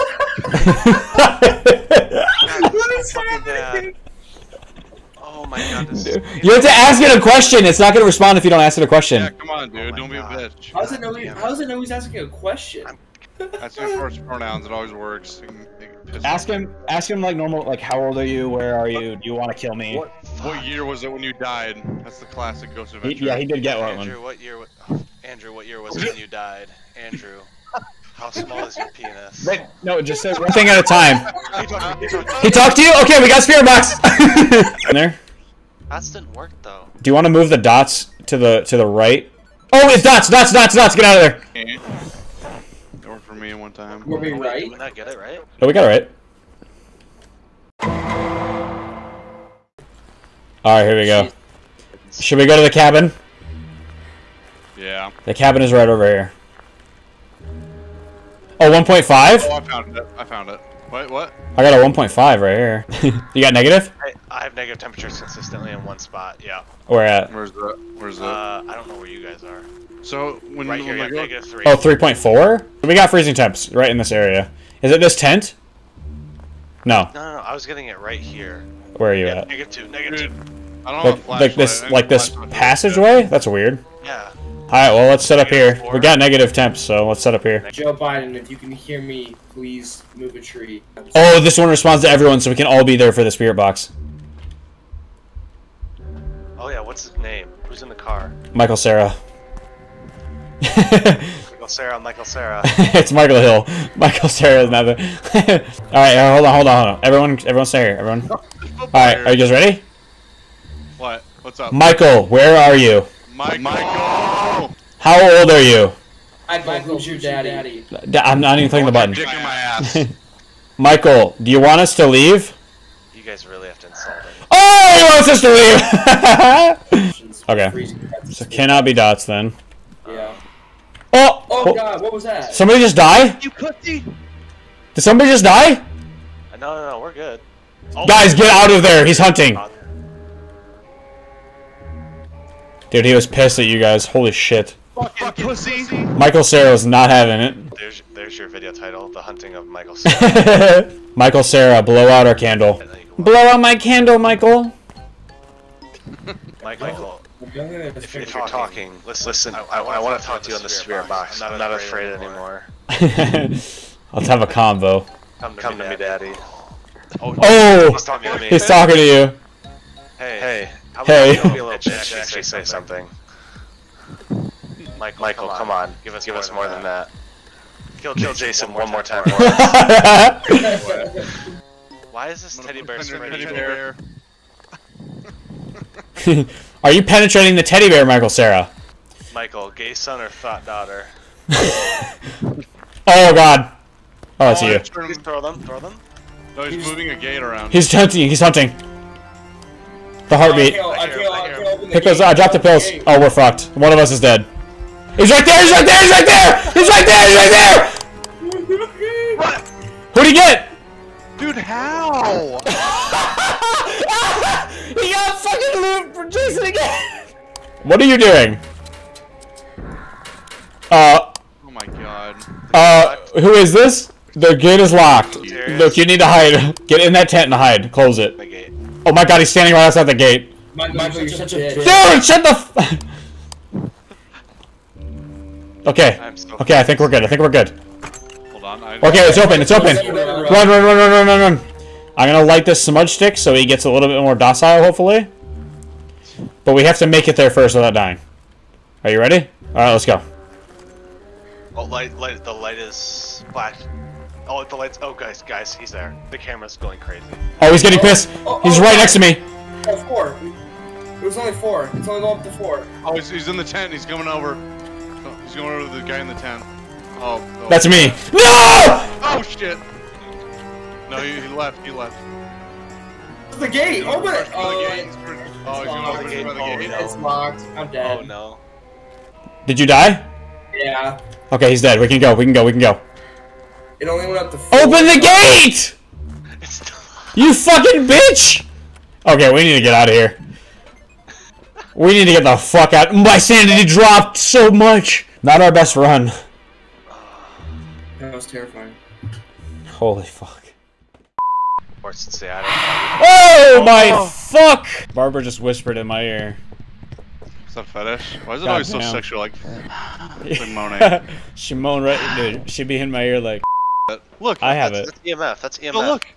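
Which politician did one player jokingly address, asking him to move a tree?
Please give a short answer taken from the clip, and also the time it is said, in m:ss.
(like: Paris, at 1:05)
Joe Biden, at 1:27.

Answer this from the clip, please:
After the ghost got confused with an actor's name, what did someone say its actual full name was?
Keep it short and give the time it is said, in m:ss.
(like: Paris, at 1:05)
Michael Hill, at 1:43.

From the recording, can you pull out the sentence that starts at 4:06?
But we have to make it there first without dying.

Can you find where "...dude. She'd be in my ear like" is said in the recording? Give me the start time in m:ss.
5:12.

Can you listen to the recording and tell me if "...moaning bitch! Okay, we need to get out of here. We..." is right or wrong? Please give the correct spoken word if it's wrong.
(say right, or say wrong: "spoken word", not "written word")
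wrong: "fucking", not "moaning".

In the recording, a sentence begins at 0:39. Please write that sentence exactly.
Oh, it's dots, dots, dots, dots.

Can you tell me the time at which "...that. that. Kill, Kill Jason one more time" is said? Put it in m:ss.
2:56.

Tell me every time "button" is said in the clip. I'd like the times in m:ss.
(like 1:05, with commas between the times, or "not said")
1:58.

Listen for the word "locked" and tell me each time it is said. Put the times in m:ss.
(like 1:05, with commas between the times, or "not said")
3:44, 4:37.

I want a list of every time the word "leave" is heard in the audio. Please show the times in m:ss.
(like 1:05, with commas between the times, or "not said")
2:02, 2:06.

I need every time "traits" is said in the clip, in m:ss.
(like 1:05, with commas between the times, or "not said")
not said.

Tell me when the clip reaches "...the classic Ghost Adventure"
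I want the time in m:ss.
0:22.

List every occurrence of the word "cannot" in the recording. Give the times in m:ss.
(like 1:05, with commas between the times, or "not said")
2:08.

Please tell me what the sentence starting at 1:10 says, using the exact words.
So when right here, when negative three.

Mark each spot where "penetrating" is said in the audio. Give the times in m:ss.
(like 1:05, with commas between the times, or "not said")
3:07.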